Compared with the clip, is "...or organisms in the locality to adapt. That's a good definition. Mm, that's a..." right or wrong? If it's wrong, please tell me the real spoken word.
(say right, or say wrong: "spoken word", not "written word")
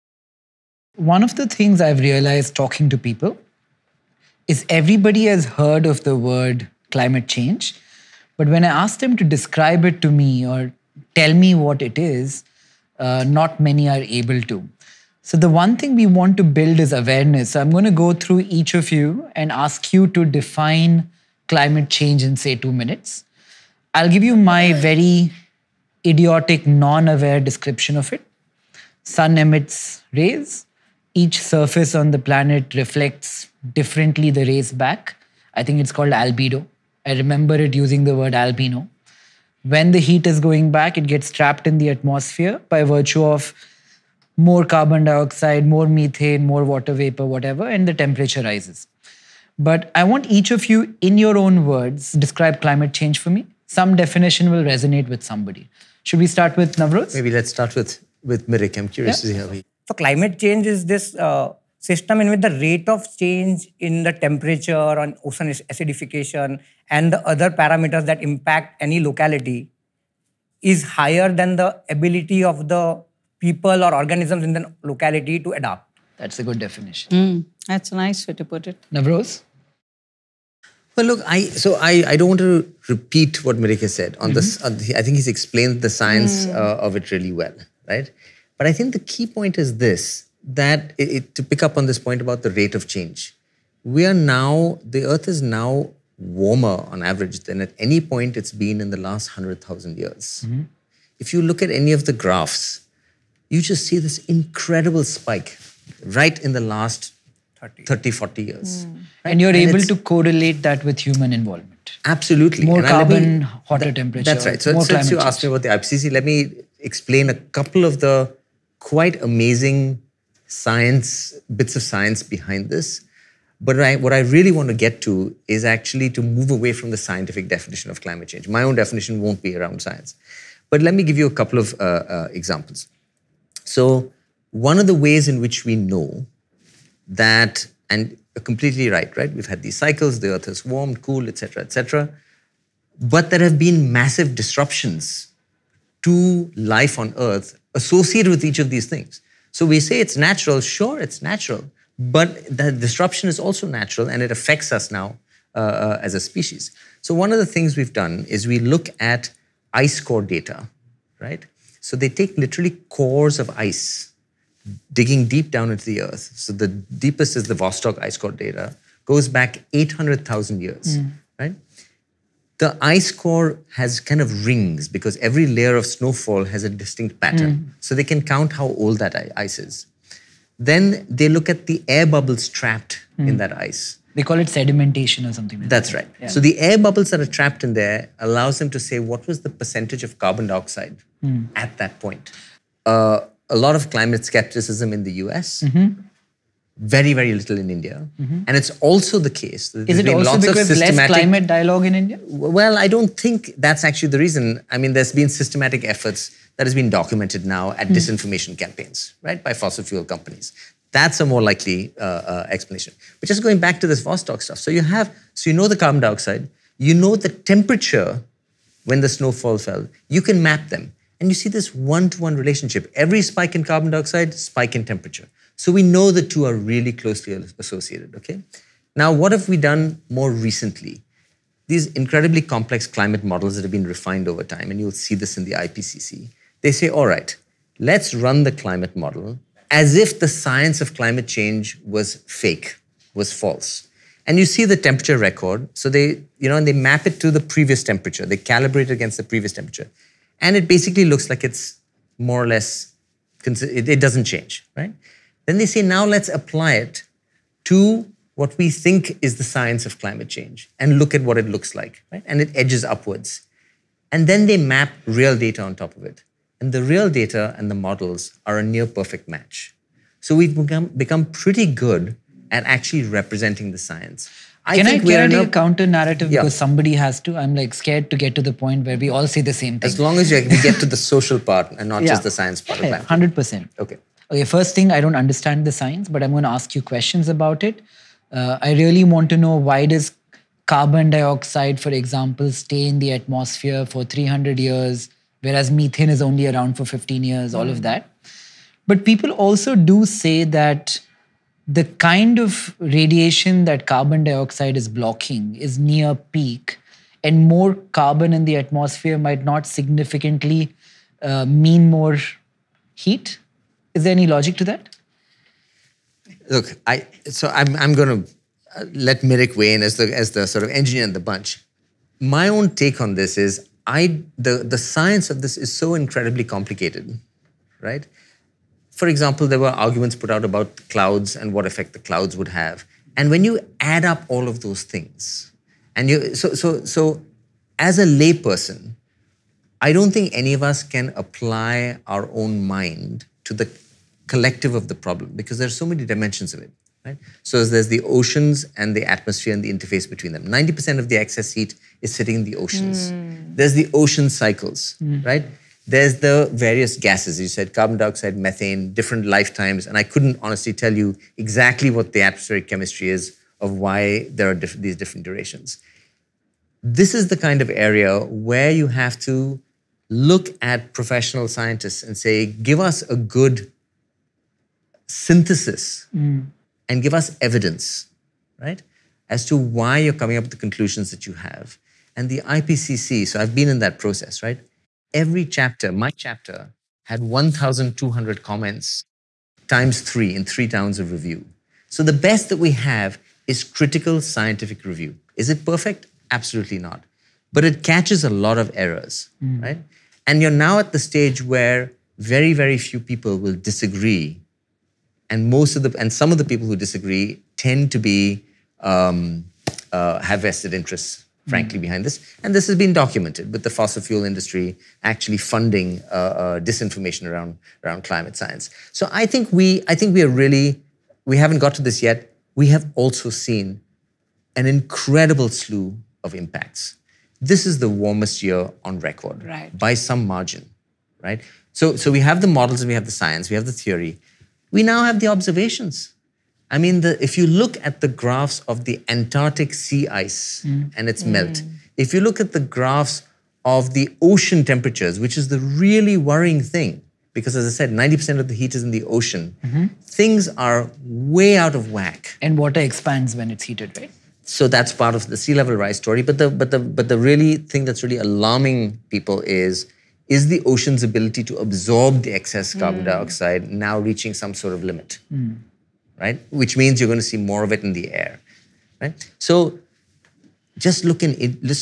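right.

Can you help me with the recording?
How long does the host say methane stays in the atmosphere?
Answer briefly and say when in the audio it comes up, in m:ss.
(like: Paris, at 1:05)
15 years, at 4:56.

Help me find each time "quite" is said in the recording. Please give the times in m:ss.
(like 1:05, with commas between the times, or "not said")
1:58.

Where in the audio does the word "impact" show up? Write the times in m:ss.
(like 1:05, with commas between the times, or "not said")
1:08, 7:06.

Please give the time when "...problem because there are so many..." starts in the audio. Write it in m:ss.
5:45.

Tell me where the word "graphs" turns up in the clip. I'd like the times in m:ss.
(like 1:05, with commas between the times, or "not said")
1:42, 7:18, 7:22.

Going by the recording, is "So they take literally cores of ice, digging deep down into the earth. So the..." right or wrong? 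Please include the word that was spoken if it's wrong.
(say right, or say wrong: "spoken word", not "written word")
right.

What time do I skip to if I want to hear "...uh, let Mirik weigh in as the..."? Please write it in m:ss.
5:18.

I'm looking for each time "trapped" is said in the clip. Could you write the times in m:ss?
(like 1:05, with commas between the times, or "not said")
0:41, 3:02, 3:07.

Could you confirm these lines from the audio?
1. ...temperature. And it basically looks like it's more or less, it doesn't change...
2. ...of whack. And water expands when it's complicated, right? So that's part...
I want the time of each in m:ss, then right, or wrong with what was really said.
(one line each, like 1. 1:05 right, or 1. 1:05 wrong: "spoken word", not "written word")
1. 4:09 right
2. 7:31 wrong: "heated", not "complicated".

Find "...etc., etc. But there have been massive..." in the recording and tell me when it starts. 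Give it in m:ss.
2:21.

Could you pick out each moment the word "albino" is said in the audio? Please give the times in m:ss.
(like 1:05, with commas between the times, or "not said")
0:38.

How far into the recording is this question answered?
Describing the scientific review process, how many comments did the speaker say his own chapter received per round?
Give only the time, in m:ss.
6:27.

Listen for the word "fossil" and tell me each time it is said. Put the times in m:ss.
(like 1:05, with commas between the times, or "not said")
3:29, 6:53.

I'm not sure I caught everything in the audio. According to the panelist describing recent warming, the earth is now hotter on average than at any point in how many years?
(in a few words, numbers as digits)
100,000 years.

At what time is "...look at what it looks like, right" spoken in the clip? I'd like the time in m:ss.
4:20.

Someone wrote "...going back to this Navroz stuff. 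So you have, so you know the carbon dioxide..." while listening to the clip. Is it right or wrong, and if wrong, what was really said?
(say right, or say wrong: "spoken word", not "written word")
wrong: "Vostok", not "Navroz".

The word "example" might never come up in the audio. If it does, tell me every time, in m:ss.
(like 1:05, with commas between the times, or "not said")
2:12, 4:51, 5:29.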